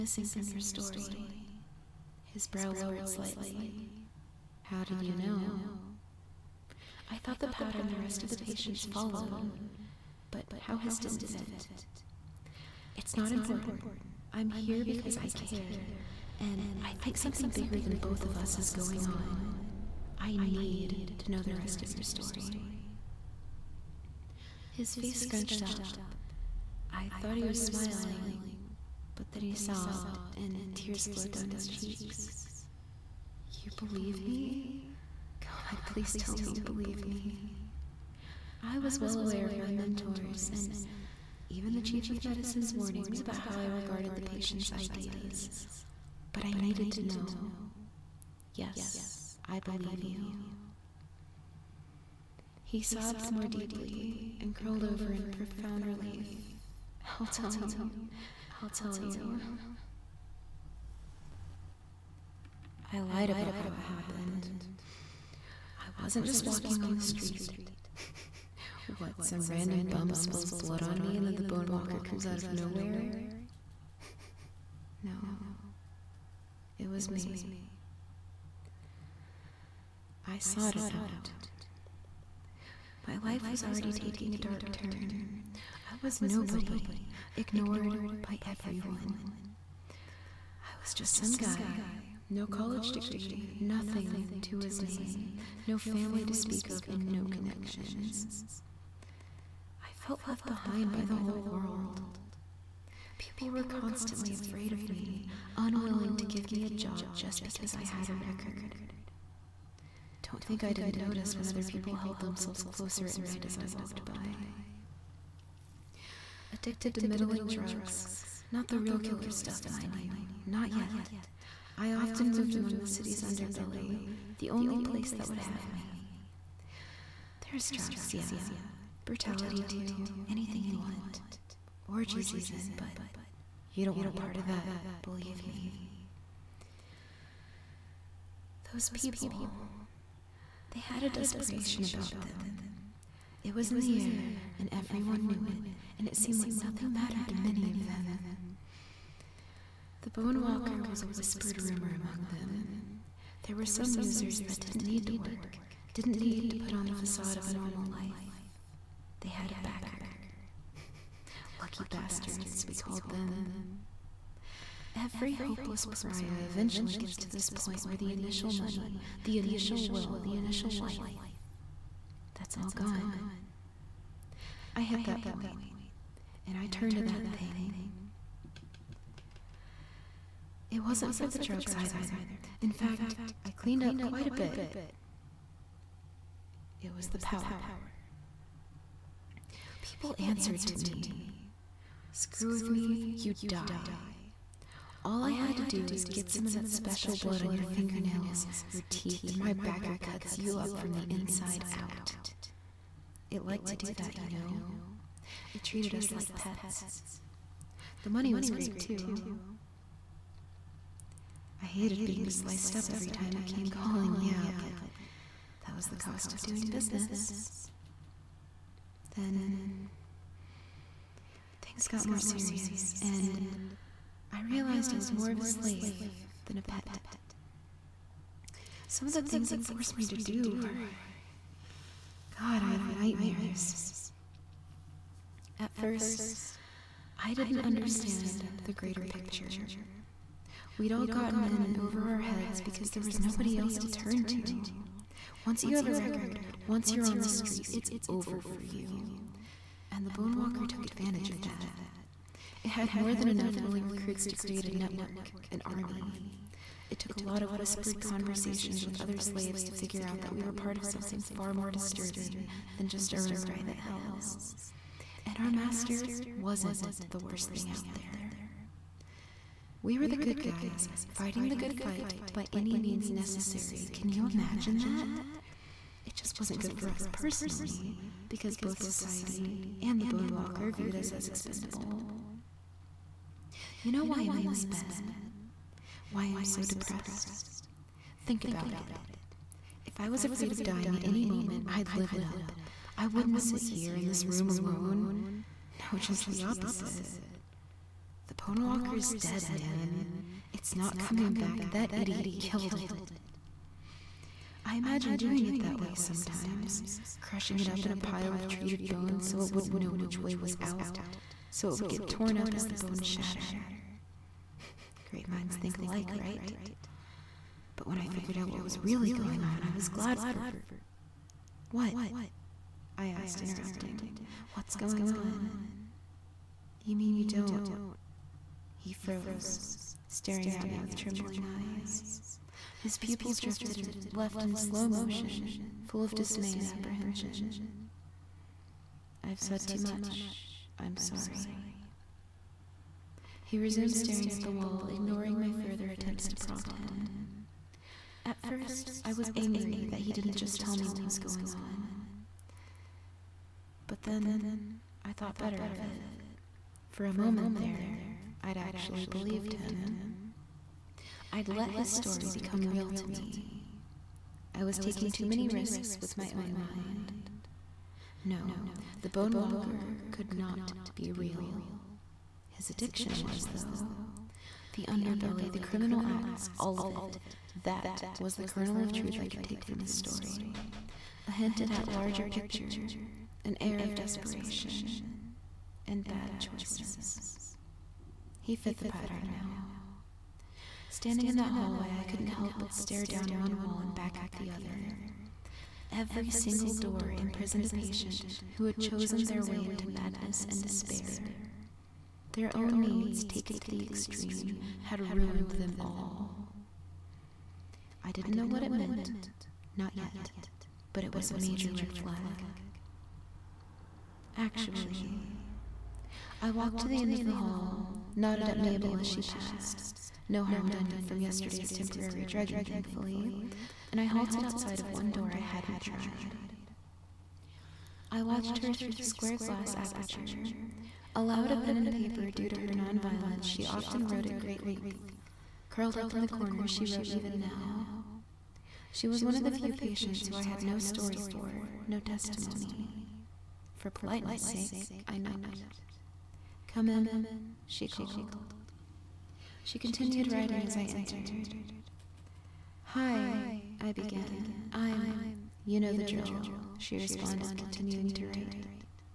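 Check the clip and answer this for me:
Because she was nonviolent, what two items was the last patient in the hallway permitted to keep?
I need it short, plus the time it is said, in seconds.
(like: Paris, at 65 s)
A pen and paper, at 431 s.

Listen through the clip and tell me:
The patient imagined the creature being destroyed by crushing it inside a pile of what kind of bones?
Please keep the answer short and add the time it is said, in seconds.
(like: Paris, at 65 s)
Treated bones, at 308 s.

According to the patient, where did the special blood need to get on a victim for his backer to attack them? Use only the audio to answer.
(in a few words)
Fingernails or teeth.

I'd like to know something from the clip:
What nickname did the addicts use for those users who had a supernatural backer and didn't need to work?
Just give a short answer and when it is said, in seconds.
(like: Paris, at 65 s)
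Lucky bastards, at 161 s.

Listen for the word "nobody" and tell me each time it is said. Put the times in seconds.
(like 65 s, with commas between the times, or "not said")
86 s, 243 s.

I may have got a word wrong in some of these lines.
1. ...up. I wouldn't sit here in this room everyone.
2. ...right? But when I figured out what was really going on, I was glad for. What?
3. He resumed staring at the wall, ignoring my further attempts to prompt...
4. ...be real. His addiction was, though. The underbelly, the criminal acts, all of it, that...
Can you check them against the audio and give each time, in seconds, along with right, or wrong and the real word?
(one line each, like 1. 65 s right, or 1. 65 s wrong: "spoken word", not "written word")
1. 292 s wrong: "alone", not "everyone"
2. 316 s right
3. 343 s right
4. 370 s right.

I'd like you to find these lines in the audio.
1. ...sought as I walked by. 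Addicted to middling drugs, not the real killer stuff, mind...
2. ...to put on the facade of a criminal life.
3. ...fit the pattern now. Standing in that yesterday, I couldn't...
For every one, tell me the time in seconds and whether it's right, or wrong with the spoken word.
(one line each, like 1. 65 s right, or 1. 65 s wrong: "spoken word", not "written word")
1. 113 s wrong: "night", not "sought"
2. 156 s wrong: "normal", not "criminal"
3. 388 s wrong: "hallway", not "yesterday".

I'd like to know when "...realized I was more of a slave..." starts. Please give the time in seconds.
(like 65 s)
224 s.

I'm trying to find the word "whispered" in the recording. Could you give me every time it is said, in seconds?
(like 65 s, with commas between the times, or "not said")
151 s, 257 s.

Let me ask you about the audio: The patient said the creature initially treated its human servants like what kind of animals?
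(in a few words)
Pets.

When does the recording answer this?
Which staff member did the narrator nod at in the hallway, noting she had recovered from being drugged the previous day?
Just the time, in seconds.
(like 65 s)
418 s.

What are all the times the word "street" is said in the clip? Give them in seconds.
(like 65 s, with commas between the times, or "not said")
66 s, 247 s.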